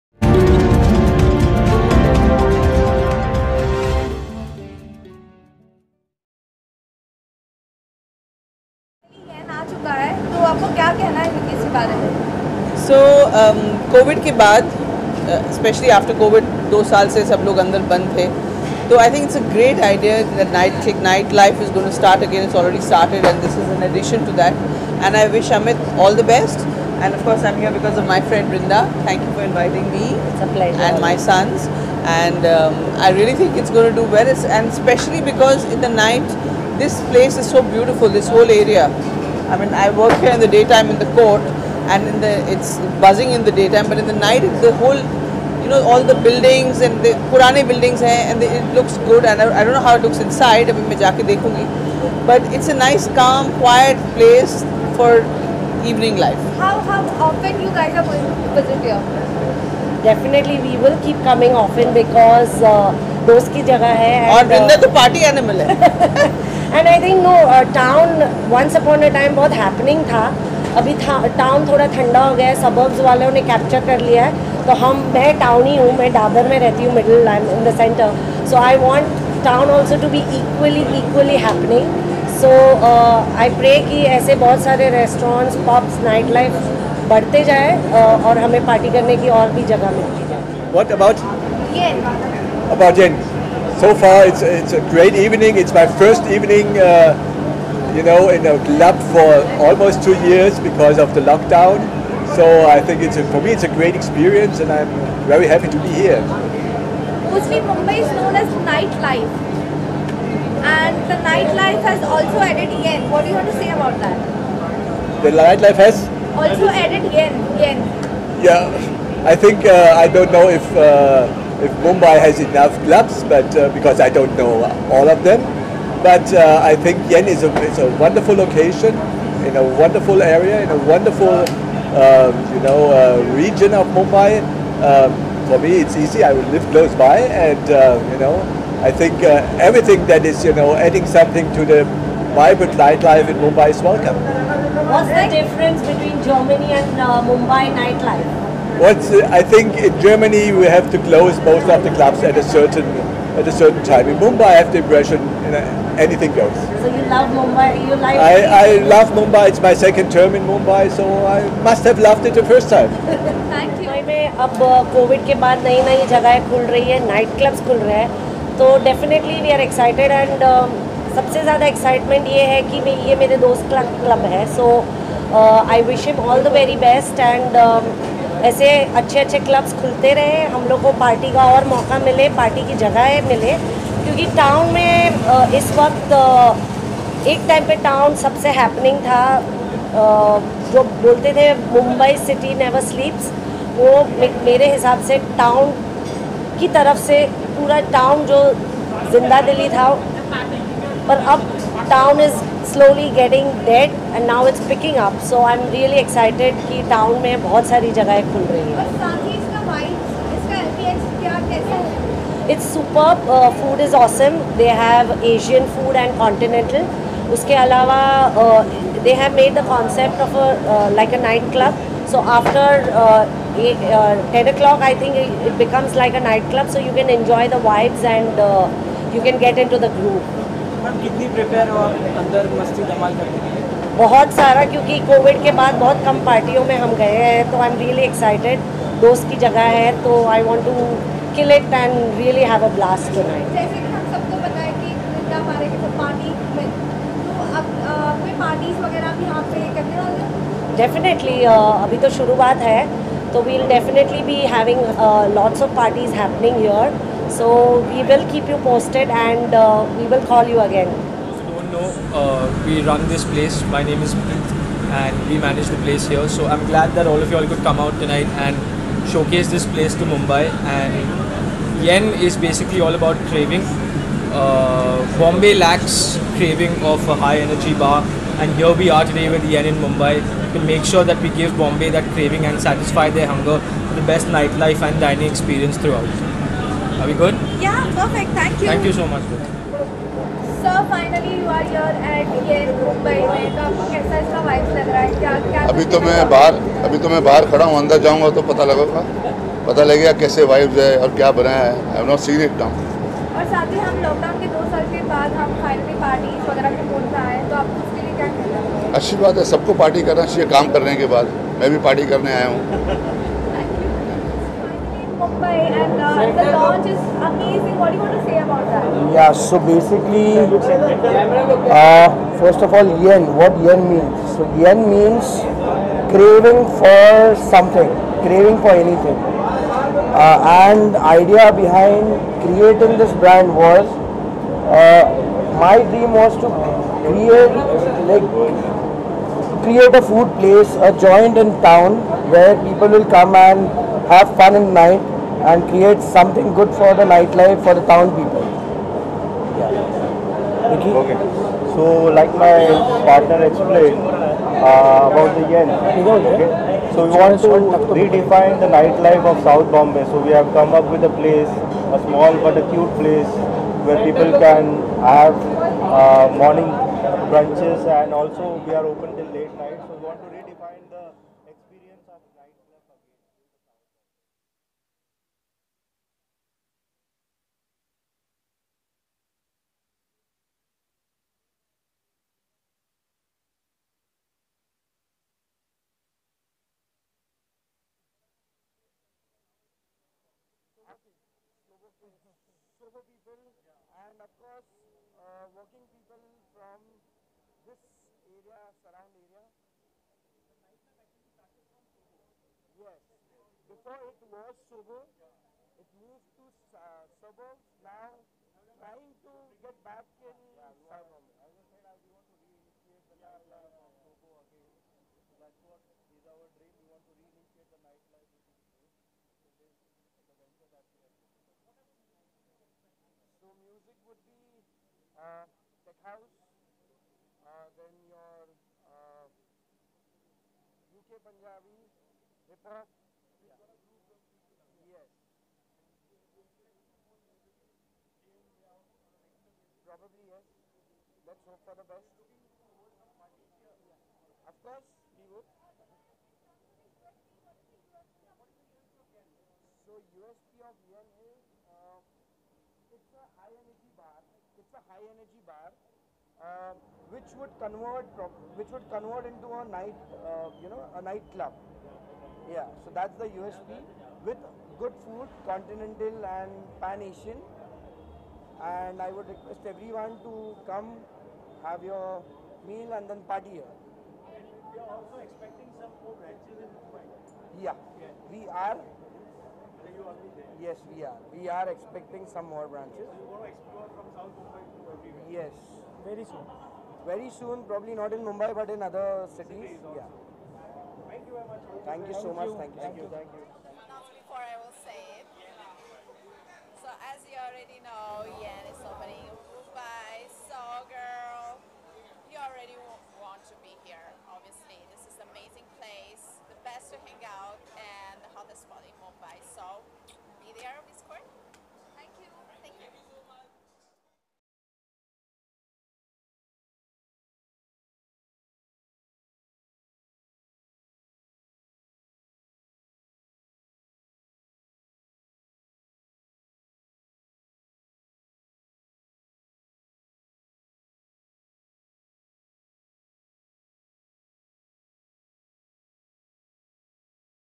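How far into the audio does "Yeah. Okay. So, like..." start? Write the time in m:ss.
5:49.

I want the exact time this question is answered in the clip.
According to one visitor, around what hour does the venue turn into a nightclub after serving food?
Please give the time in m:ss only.
3:44.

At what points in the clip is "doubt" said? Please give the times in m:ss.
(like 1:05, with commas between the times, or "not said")
not said.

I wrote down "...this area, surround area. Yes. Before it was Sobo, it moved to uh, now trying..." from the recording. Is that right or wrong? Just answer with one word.
right.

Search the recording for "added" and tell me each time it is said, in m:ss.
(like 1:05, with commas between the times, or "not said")
1:52, 1:56.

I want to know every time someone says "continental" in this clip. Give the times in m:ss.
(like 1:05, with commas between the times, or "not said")
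3:36, 7:45.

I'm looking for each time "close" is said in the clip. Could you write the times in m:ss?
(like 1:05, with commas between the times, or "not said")
2:16, 2:31.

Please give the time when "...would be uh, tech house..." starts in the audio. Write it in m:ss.
7:04.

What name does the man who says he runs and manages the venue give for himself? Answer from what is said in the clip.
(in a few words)
Prith.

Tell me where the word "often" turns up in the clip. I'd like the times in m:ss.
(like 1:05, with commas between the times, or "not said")
0:57, 1:01.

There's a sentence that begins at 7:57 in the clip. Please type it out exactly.
Yeah, yeah, we are you already there?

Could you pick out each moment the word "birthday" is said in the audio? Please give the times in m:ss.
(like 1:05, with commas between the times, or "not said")
not said.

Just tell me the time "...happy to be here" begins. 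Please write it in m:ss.
1:45.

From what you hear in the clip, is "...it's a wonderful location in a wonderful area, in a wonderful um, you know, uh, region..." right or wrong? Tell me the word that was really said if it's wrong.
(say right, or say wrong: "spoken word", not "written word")
right.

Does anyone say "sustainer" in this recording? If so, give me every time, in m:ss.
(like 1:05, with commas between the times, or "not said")
not said.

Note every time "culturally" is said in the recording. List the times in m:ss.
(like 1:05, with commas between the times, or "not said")
not said.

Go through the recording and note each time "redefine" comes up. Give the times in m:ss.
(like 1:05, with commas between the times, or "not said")
5:57, 6:10.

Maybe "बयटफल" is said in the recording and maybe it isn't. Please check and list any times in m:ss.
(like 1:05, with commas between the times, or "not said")
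0:37.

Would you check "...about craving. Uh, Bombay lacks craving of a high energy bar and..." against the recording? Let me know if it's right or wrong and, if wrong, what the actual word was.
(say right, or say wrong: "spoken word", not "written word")
right.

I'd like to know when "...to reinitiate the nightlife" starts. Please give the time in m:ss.
6:57.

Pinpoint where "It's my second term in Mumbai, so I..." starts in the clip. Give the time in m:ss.
2:39.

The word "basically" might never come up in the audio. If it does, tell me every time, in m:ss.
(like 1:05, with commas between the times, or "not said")
4:32, 5:19.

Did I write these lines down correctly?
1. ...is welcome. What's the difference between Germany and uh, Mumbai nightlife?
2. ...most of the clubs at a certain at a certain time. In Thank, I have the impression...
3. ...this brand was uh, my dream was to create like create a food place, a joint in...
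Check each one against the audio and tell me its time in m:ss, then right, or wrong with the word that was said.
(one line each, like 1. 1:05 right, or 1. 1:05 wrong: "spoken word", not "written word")
1. 2:23 right
2. 2:31 wrong: "Mumbai", not "Thank"
3. 5:32 right.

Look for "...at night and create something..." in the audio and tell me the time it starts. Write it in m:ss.
5:44.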